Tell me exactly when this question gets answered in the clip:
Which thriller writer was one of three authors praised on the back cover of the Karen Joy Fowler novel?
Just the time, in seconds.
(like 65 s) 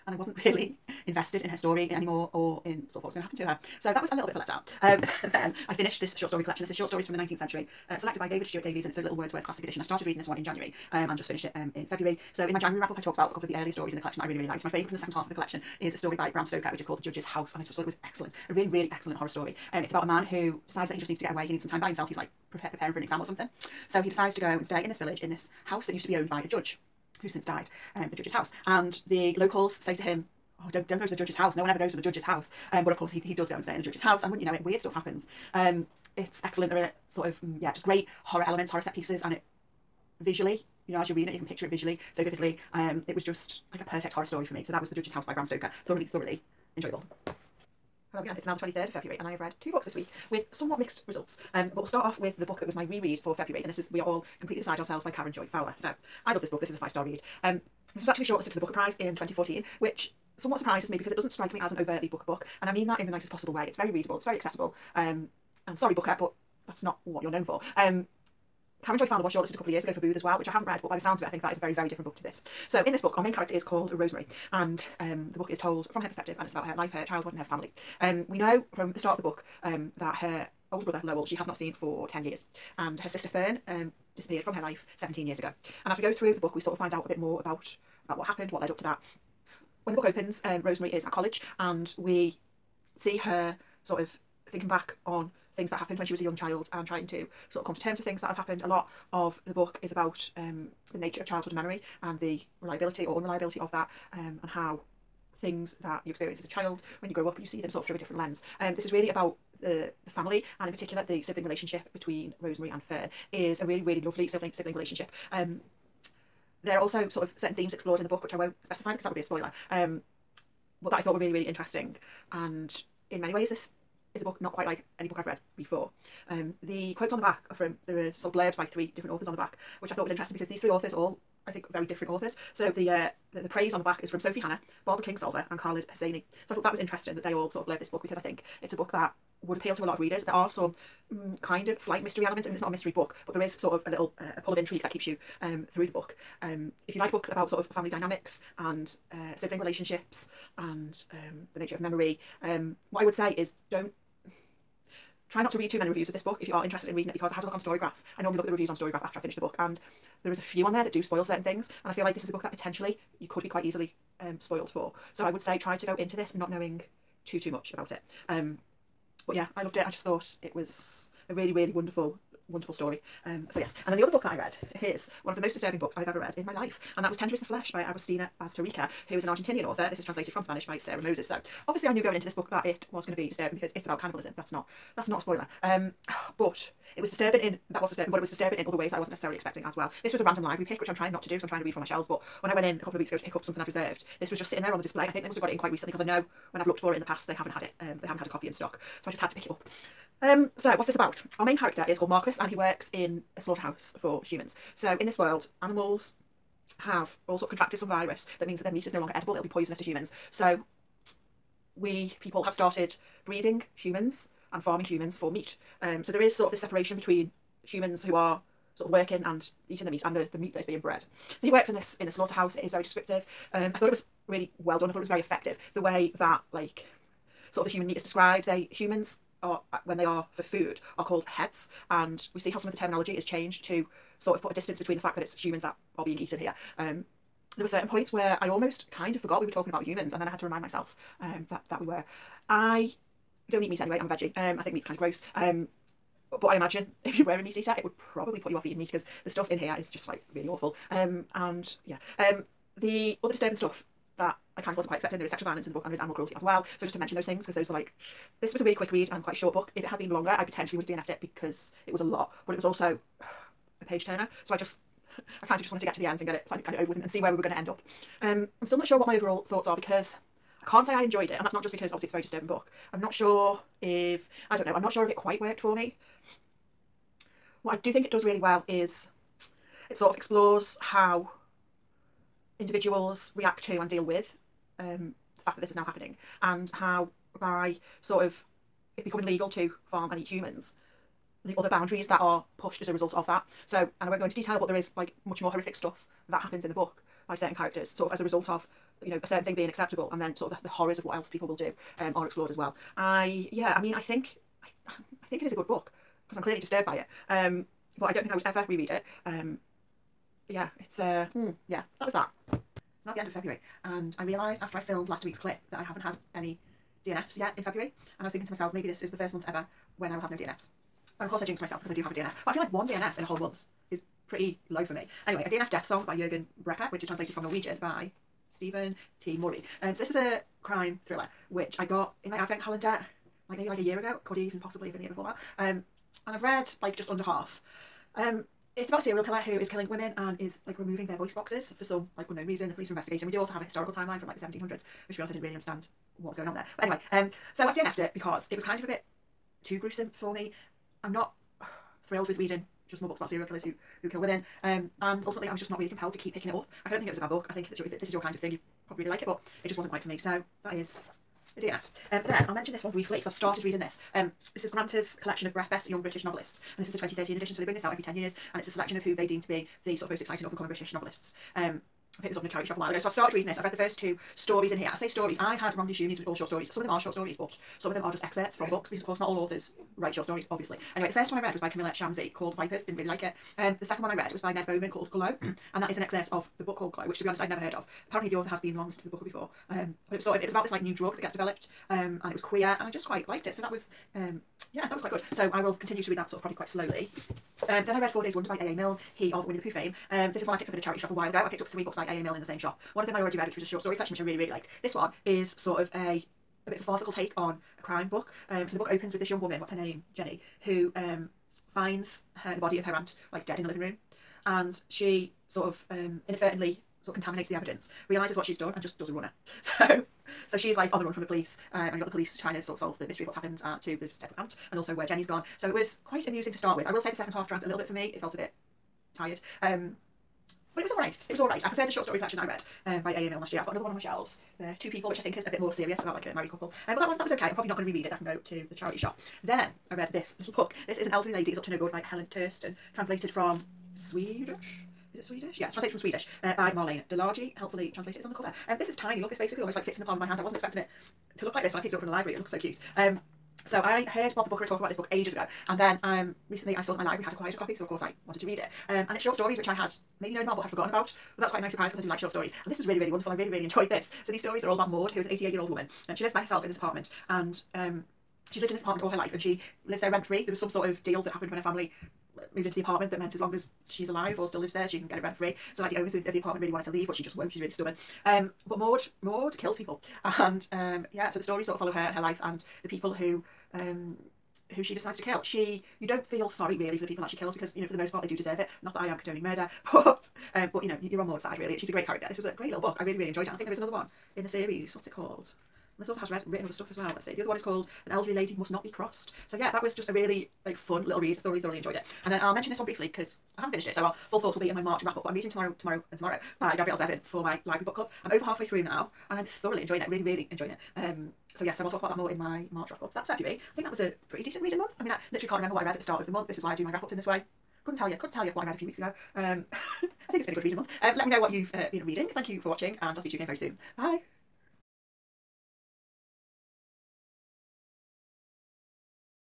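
134 s.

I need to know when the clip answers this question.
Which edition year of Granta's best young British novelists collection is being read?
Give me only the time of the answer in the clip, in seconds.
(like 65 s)
366 s.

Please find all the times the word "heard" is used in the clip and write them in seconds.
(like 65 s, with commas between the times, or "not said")
387 s, 454 s.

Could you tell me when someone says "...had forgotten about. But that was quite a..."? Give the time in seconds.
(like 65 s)
460 s.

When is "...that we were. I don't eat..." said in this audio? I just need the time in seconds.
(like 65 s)
241 s.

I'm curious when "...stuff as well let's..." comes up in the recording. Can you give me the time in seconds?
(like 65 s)
496 s.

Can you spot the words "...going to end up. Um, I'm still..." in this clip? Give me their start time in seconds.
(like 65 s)
267 s.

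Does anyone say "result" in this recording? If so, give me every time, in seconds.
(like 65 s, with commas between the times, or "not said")
51 s, 292 s, 298 s.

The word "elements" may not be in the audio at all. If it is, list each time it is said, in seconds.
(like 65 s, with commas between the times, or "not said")
38 s, 142 s.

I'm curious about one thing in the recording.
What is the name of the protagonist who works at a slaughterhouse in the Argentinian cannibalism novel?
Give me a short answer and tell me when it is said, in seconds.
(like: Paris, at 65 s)
Marcus, at 202 s.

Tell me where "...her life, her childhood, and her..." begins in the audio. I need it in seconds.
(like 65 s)
76 s.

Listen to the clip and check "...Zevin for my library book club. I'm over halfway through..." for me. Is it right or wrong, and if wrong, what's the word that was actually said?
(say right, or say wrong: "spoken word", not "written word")
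right.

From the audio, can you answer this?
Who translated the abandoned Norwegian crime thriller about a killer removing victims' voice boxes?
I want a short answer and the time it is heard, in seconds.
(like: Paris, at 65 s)
Steven T. Murray, at 328 s.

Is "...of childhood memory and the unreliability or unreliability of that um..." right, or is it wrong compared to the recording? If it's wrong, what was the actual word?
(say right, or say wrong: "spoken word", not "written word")
wrong: "reliability", not "unreliability".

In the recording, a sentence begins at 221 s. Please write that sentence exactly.
So he works in this in the slaughterhouse.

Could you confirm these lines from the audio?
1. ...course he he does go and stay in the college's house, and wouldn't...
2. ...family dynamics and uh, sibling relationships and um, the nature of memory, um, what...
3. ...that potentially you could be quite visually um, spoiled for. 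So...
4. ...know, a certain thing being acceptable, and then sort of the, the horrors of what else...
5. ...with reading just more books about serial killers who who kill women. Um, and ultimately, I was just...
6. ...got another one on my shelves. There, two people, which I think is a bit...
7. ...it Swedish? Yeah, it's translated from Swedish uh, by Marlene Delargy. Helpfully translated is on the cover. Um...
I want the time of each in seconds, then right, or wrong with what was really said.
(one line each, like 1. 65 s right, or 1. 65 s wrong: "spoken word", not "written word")
1. 32 s wrong: "judge", not "college"
2. 147 s right
3. 162 s wrong: "easily", not "visually"
4. 299 s right
5. 352 s right
6. 433 s right
7. 445 s right.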